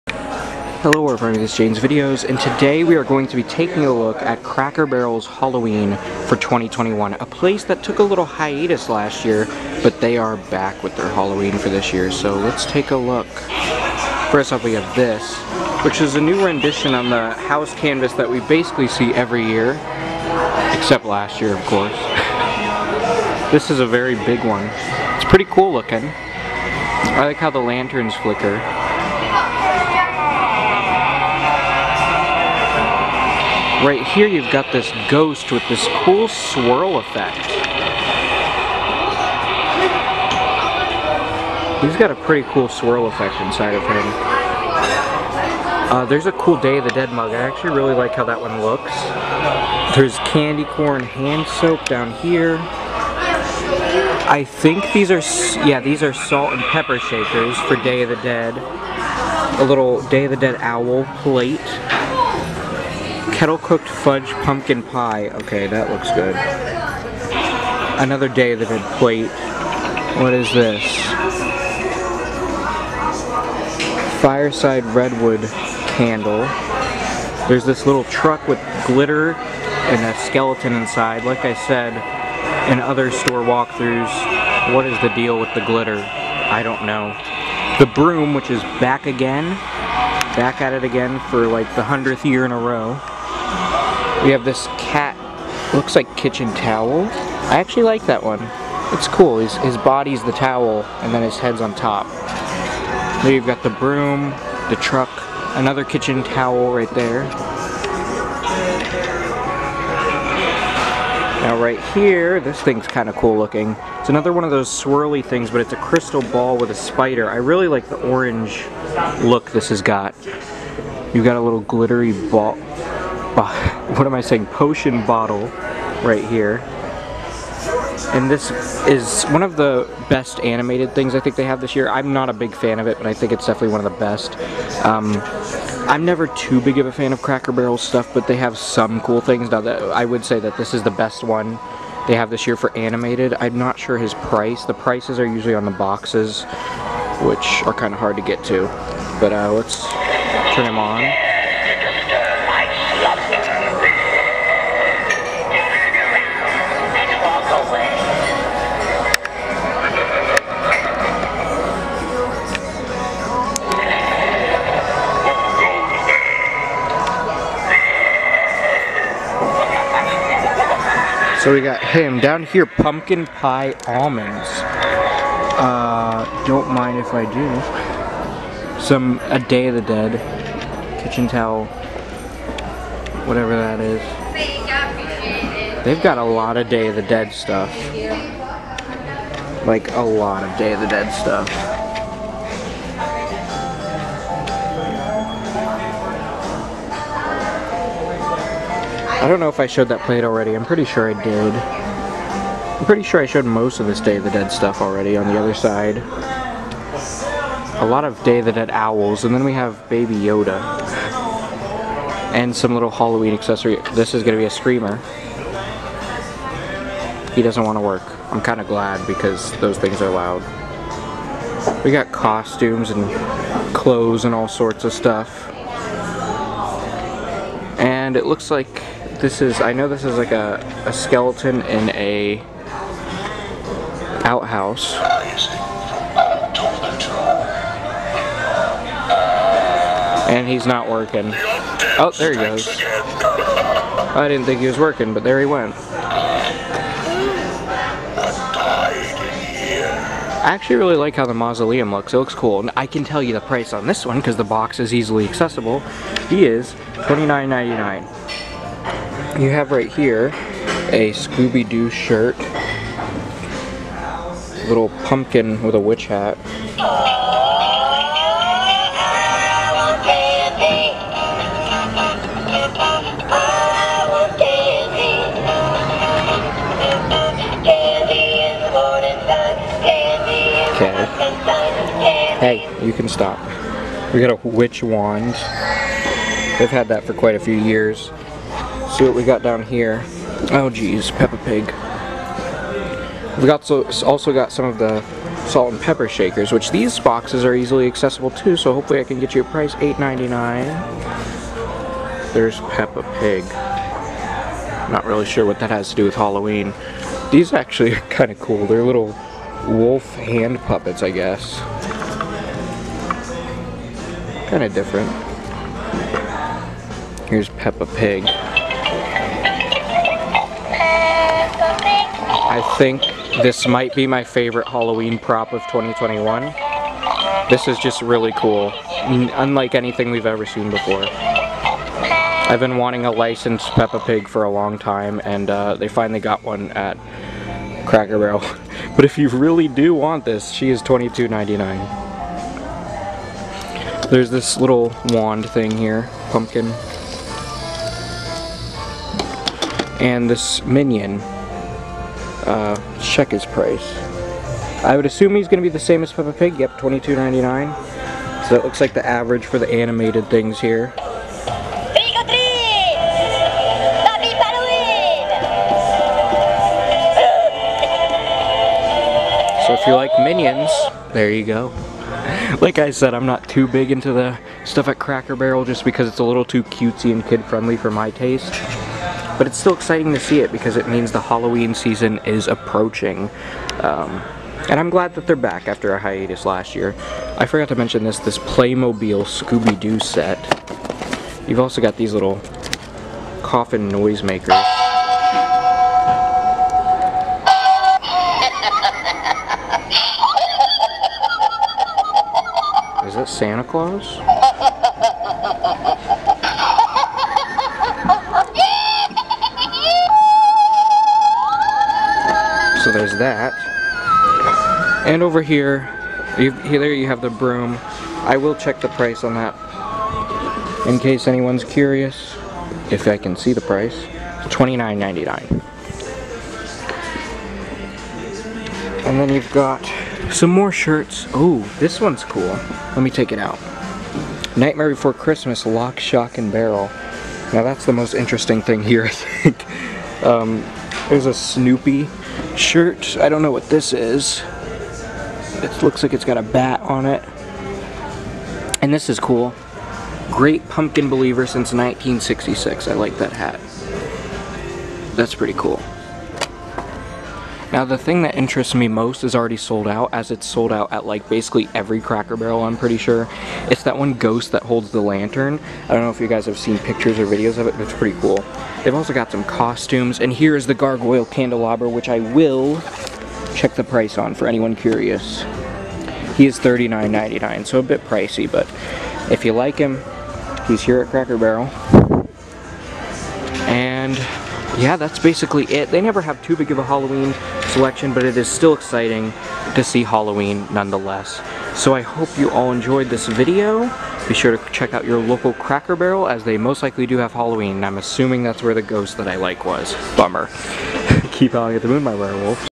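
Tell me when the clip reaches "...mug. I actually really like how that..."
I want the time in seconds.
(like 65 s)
47 s.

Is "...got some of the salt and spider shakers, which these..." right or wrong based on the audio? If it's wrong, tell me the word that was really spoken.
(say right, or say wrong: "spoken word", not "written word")
wrong: "pepper", not "spider".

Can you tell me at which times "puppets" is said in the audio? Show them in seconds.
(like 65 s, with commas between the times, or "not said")
310 s.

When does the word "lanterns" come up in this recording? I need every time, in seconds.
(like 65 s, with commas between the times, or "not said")
27 s, 464 s.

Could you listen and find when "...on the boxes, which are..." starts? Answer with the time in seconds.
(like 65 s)
145 s.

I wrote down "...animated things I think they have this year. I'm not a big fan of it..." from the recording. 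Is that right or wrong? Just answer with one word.
right.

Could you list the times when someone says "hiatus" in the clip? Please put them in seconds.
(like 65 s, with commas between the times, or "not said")
8 s, 385 s.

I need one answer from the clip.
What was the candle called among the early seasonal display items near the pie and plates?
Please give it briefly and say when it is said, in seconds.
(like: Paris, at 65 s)
Fireside redwood, at 74 s.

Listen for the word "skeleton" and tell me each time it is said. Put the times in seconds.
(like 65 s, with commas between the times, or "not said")
80 s, 230 s.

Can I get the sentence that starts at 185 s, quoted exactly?
They've got a lot of Day of the Dead stuff.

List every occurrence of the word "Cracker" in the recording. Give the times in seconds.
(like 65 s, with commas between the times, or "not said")
4 s, 137 s, 337 s, 374 s, 462 s, 481 s, 495 s.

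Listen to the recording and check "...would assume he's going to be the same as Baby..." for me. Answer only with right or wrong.
wrong.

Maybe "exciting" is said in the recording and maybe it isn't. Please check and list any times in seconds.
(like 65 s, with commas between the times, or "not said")
379 s, 488 s.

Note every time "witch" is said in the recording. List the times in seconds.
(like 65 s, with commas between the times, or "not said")
265 s, 284 s.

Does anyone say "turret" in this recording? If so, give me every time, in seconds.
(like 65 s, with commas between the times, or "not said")
not said.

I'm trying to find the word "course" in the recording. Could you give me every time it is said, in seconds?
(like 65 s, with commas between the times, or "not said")
21 s.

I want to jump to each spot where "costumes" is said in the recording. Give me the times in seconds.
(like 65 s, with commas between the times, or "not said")
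222 s, 469 s.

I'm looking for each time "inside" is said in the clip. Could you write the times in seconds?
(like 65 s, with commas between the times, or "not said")
43 s, 80 s.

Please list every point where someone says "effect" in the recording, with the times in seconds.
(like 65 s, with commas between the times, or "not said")
36 s, 43 s.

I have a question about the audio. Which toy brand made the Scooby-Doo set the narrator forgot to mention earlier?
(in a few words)
Playmobil.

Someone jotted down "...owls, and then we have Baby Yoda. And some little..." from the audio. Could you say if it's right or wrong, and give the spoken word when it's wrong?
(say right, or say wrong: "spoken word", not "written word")
right.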